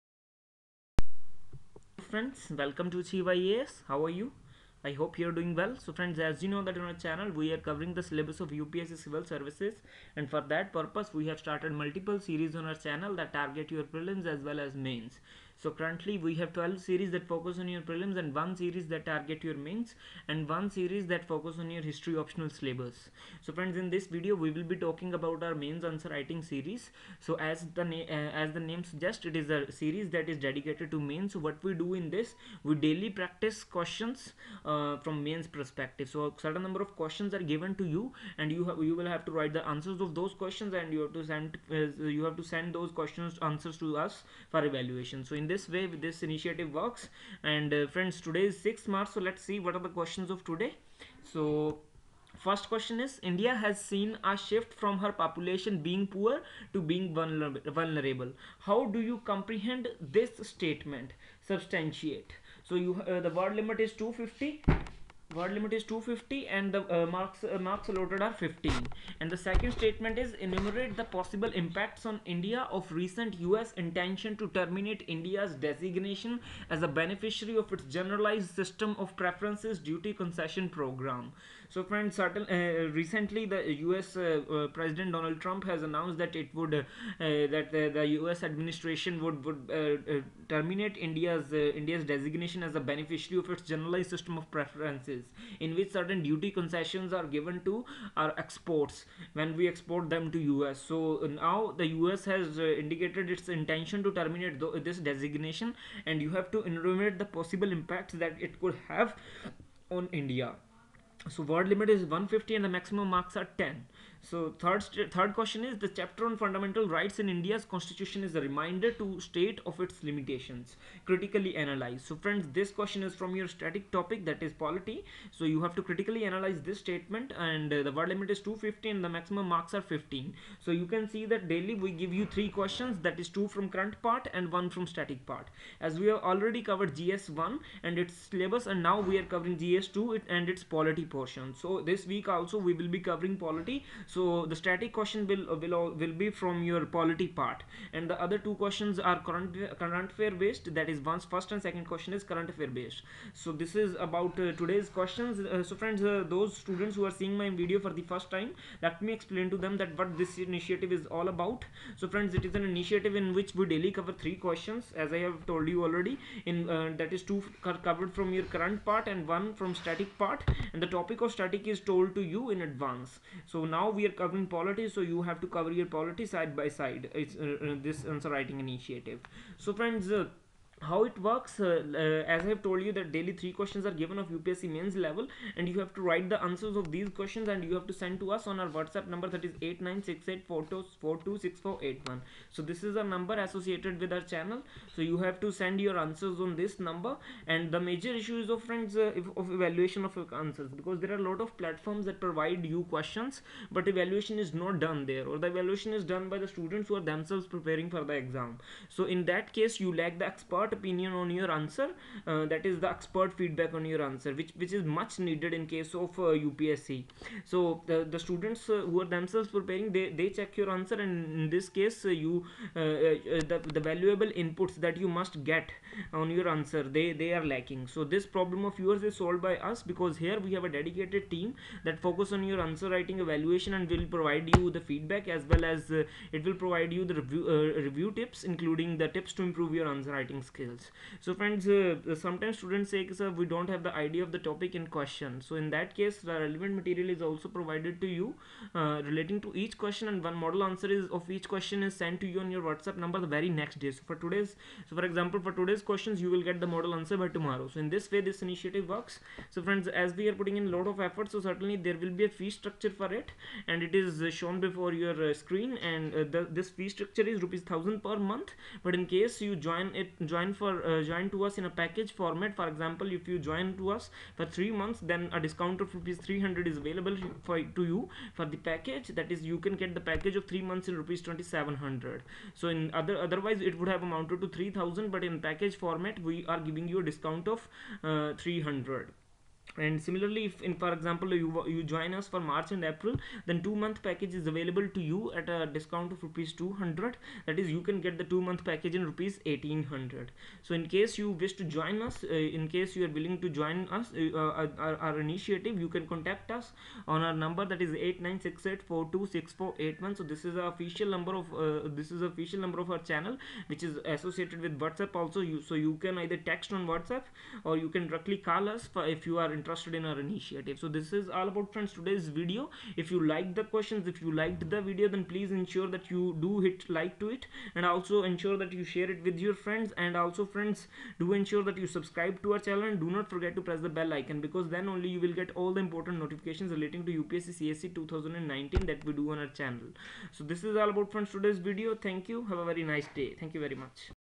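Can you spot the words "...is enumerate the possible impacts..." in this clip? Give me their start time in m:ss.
1:10.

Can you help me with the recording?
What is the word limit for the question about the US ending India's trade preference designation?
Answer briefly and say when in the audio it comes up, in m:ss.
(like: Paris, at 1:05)
150, at 1:52.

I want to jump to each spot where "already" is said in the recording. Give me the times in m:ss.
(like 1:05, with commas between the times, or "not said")
2:16, 2:45.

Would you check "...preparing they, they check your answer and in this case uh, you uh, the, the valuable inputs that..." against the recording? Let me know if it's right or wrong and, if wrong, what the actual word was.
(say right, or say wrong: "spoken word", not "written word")
right.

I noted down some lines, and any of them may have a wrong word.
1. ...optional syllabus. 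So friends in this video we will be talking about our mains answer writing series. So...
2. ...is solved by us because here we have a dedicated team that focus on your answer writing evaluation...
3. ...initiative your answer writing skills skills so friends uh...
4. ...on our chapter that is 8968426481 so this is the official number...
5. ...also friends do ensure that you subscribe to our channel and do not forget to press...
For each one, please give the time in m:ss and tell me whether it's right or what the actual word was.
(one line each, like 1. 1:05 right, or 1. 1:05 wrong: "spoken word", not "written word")
1. 0:22 right
2. 3:49 right
3. 3:59 wrong: "improve", not "initiative"
4. 5:07 wrong: "number", not "chapter"
5. 5:30 right.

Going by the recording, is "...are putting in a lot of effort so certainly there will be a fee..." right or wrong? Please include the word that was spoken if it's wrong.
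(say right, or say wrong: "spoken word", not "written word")
right.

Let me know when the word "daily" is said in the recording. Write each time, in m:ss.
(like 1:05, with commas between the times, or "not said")
0:32, 2:11, 2:43, 3:03.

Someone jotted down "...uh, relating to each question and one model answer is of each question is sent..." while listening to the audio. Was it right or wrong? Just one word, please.
right.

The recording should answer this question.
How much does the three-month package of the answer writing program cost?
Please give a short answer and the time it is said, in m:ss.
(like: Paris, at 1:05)
Rs 2700, at 4:41.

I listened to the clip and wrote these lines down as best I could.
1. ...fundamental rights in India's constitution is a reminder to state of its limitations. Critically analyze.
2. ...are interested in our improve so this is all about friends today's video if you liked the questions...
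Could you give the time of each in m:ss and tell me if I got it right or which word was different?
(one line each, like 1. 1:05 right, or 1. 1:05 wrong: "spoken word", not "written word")
1. 1:56 right
2. 5:19 wrong: "initiative", not "improve".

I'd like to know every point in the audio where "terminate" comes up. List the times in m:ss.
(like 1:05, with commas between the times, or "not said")
1:14, 1:30, 1:44.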